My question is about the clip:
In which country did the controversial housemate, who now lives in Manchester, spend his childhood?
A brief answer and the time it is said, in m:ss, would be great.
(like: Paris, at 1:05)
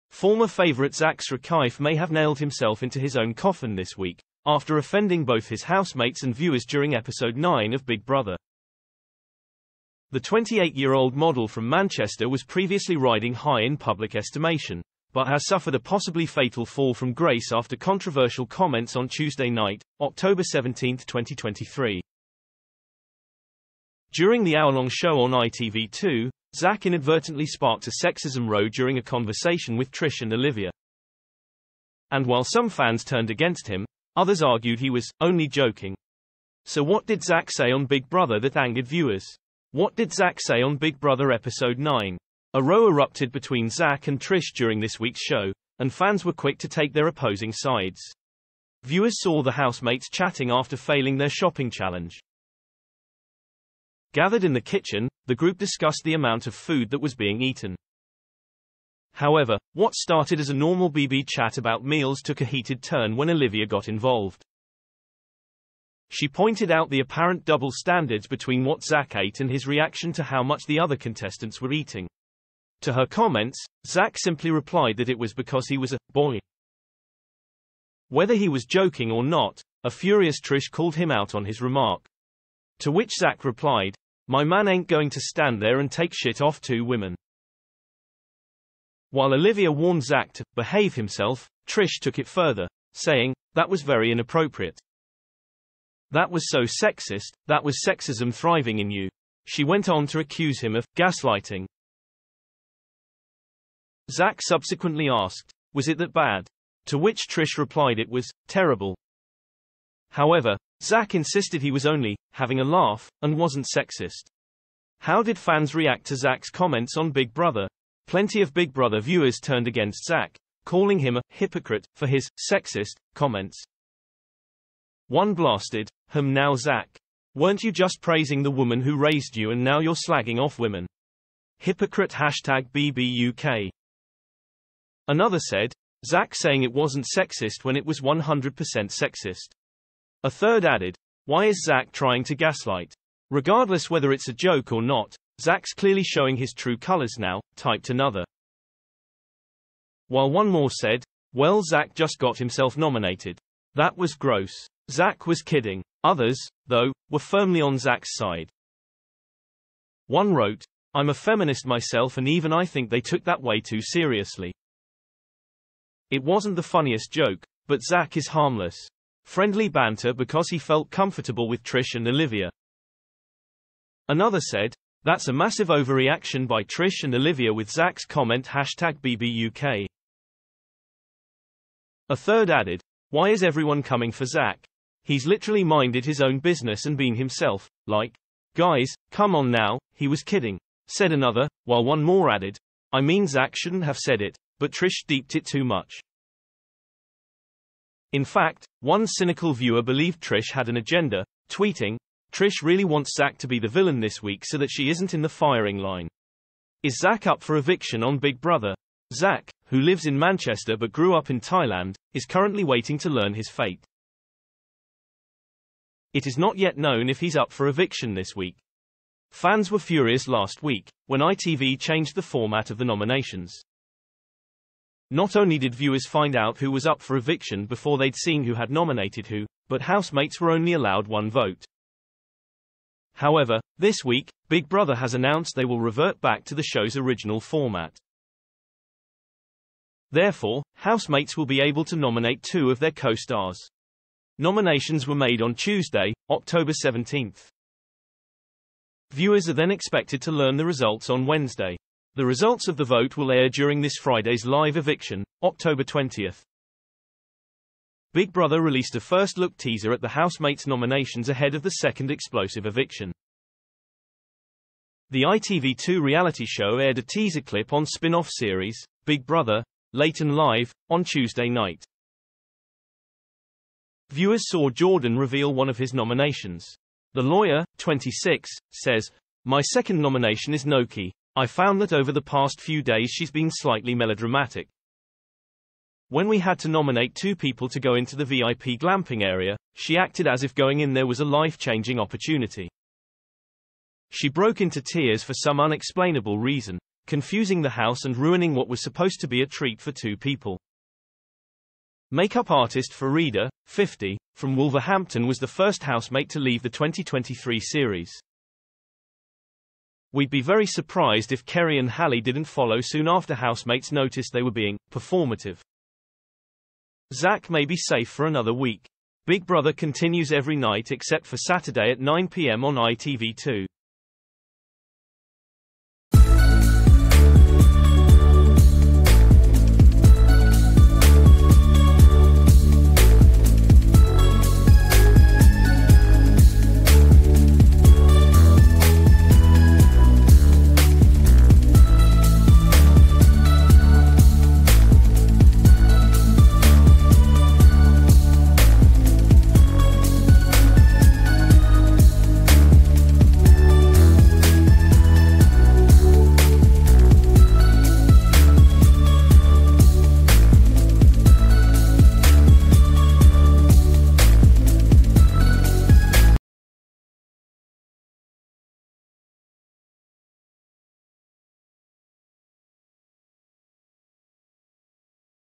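Thailand, at 3:31.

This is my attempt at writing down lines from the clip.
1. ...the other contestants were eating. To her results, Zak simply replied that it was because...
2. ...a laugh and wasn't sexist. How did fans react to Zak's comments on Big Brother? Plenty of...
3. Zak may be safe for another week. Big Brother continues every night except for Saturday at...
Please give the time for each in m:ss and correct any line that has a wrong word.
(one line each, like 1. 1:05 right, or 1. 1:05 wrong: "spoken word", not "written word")
1. 1:10 wrong: "comments", not "results"
2. 1:52 right
3. 5:17 right.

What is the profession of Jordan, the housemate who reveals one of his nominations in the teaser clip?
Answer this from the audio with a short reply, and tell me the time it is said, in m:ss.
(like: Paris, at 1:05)
Lawyer, at 4:37.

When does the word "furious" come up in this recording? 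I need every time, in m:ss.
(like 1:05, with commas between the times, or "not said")
1:19, 3:39.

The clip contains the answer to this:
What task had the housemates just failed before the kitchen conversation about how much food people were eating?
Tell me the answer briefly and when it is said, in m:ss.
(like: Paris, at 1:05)
Shopping challenge, at 0:51.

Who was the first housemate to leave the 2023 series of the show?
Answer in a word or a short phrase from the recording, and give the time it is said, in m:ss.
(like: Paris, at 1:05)
Farida, at 5:02.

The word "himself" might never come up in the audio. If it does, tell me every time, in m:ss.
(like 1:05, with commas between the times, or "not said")
0:02, 1:30, 2:32, 3:07.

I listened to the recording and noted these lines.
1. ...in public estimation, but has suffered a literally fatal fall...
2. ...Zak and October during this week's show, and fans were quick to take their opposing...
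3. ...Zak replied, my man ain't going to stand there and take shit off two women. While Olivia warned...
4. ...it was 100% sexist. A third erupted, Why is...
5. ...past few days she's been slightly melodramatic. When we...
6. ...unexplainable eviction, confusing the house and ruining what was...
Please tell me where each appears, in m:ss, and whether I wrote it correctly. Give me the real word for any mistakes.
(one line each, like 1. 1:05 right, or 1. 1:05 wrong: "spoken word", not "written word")
1. 0:13 wrong: "possibly", not "literally"
2. 0:43 wrong: "Trish", not "October"
3. 1:23 right
4. 2:17 wrong: "added", not "erupted"
5. 4:42 right
6. 4:55 wrong: "reason", not "eviction".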